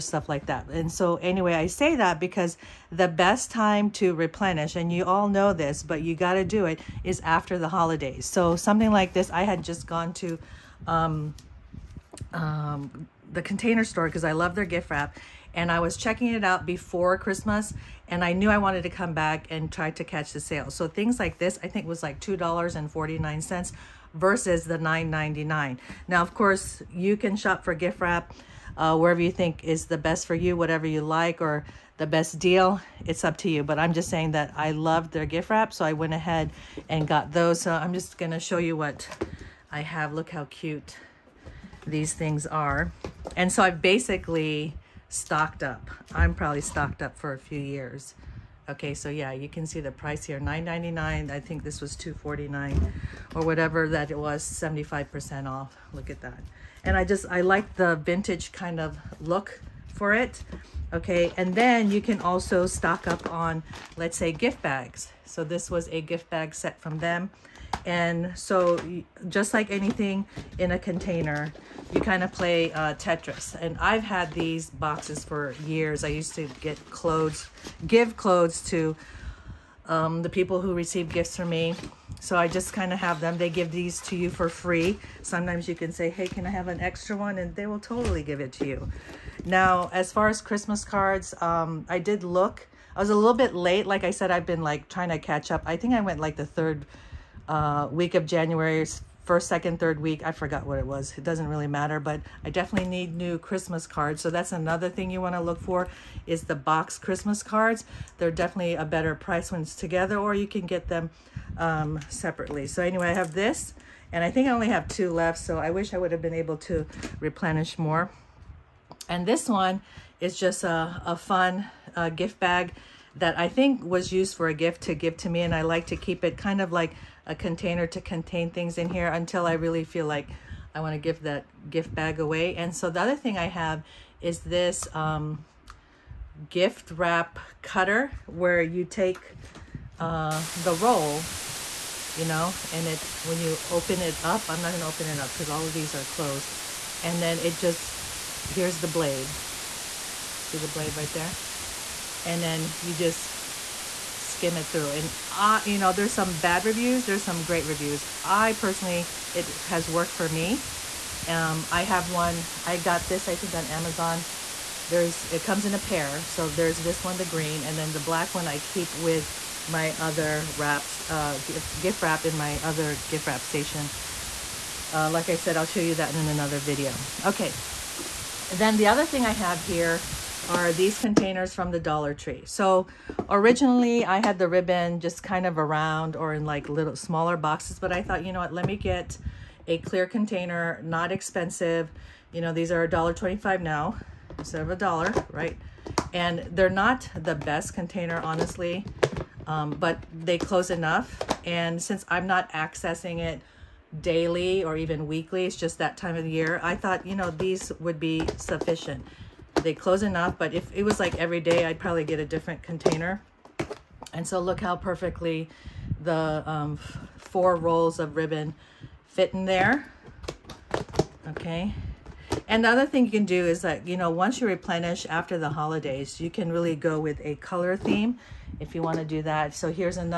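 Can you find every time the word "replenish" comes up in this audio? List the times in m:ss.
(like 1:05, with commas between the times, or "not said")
0:04, 1:57, 3:44.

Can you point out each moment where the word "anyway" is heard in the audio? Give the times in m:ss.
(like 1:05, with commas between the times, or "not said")
0:01, 1:52.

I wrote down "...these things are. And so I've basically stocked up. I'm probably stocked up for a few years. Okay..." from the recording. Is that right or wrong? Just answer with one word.
right.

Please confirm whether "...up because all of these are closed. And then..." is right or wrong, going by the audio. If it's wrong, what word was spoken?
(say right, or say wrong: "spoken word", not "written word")
right.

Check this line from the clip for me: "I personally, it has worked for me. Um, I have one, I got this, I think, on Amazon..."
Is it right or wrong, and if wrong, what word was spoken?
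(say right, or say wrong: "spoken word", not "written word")
right.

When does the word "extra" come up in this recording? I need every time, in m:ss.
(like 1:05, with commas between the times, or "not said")
1:26.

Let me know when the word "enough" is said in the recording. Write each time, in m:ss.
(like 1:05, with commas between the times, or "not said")
3:20, 3:30.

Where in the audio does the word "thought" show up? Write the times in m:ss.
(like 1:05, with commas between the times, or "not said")
3:08, 3:26.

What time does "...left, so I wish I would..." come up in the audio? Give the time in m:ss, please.
1:55.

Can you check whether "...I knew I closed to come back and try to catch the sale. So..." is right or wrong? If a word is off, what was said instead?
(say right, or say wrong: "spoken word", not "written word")
wrong: "wanted", not "closed".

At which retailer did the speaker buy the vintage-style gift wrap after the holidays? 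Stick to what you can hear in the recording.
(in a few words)
The Container Store.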